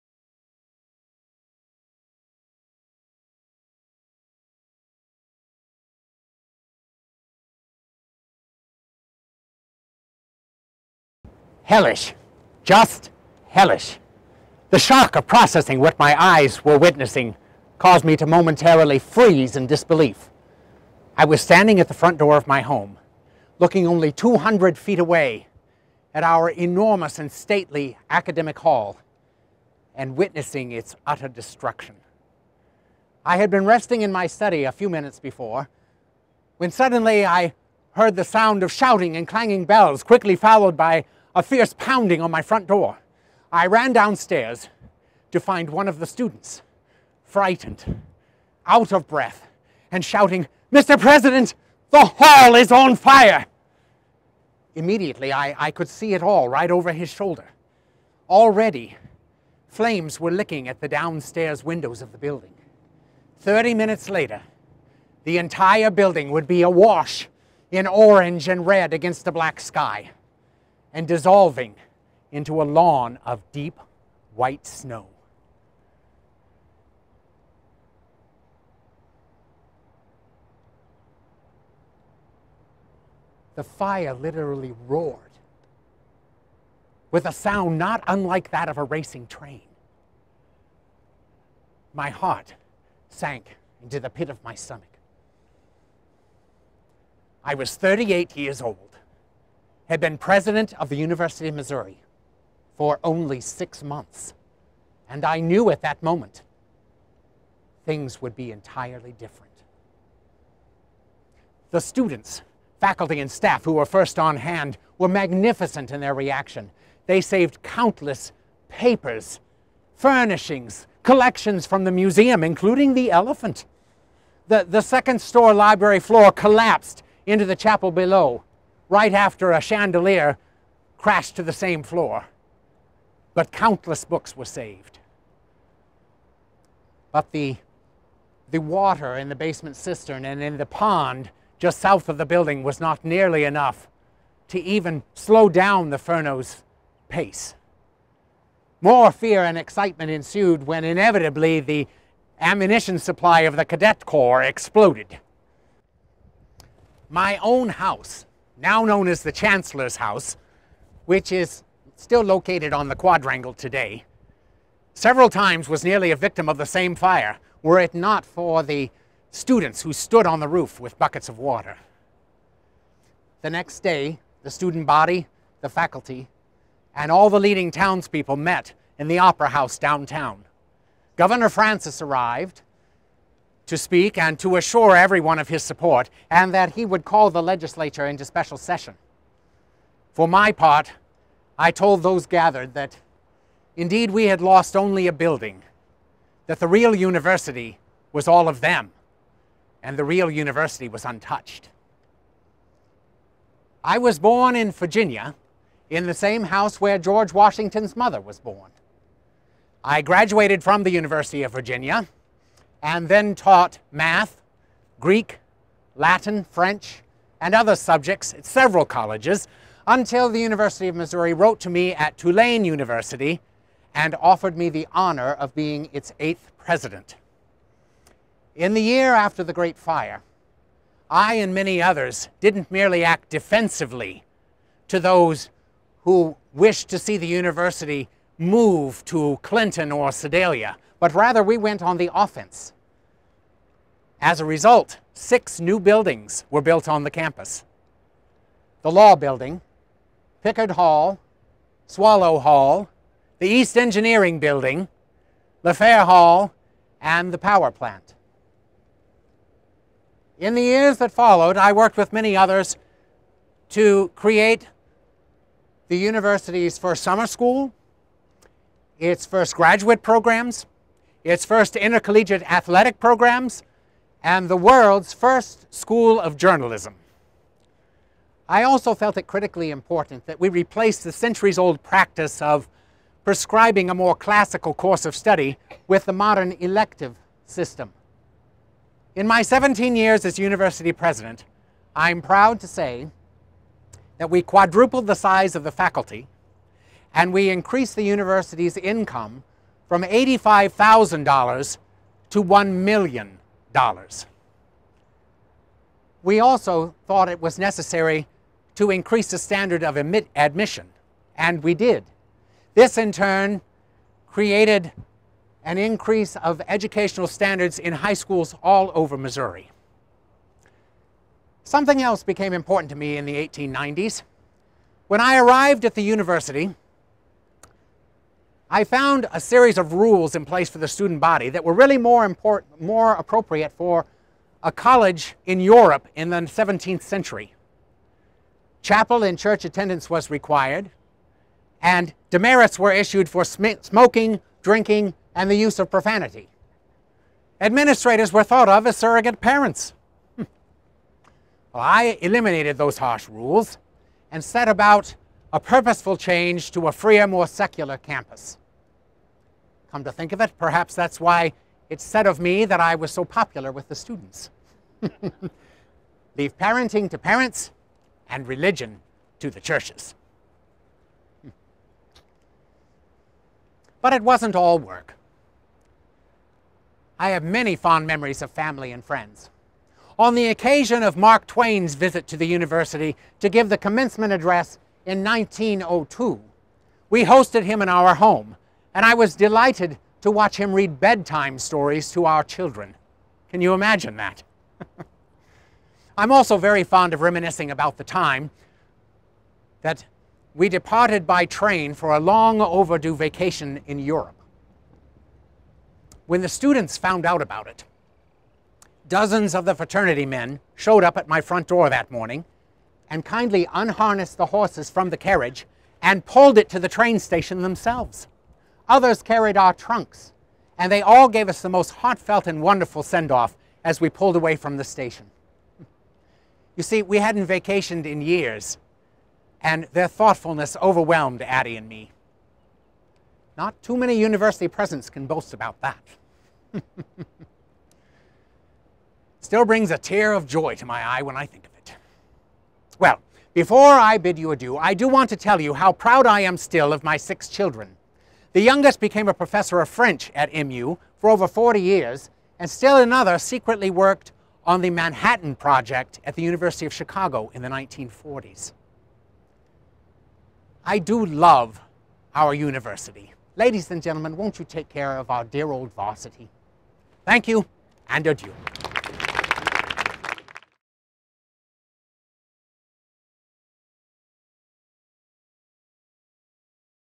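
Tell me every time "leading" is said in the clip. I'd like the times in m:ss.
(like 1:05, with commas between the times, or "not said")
2:57.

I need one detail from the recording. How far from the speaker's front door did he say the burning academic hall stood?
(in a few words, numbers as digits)
200 feet.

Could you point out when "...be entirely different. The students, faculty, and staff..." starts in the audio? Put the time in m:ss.
1:48.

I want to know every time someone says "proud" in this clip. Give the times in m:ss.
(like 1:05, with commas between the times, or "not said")
4:52, 7:25.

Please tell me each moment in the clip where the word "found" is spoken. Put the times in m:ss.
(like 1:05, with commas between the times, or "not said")
5:28, 6:46.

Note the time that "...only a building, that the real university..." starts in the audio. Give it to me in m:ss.
3:14.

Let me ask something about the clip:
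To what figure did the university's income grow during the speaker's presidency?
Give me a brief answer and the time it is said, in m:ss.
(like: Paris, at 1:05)
$1 million, at 5:02.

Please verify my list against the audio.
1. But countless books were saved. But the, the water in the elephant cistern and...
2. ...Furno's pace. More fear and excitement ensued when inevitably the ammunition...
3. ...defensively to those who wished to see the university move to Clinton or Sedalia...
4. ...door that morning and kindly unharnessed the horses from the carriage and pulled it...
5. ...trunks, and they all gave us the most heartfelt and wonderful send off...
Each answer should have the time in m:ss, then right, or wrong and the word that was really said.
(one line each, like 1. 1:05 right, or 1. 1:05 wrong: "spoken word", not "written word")
1. 2:13 wrong: "basement", not "elephant"
2. 2:25 right
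3. 3:53 right
4. 6:51 right
5. 6:59 right.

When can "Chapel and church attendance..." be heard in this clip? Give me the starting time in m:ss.
5:38.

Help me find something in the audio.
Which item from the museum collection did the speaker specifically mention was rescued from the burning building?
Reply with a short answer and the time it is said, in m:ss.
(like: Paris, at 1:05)
the elephant, at 2:02.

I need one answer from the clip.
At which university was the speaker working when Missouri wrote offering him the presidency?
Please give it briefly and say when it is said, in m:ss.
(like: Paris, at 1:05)
Tulane University, at 3:42.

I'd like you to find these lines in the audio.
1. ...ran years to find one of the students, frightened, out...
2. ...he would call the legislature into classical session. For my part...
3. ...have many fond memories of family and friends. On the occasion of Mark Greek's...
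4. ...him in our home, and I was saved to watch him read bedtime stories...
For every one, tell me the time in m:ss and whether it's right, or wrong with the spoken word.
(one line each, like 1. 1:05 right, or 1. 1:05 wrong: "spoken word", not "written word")
1. 0:43 wrong: "downstairs", not "years"
2. 3:06 wrong: "special", not "classical"
3. 6:17 wrong: "Twain", not "Greek"
4. 6:27 wrong: "delighted", not "saved".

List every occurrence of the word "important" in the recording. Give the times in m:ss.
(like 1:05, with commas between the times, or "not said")
4:39, 5:22.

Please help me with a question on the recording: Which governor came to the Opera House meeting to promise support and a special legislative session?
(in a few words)
Governor Francis.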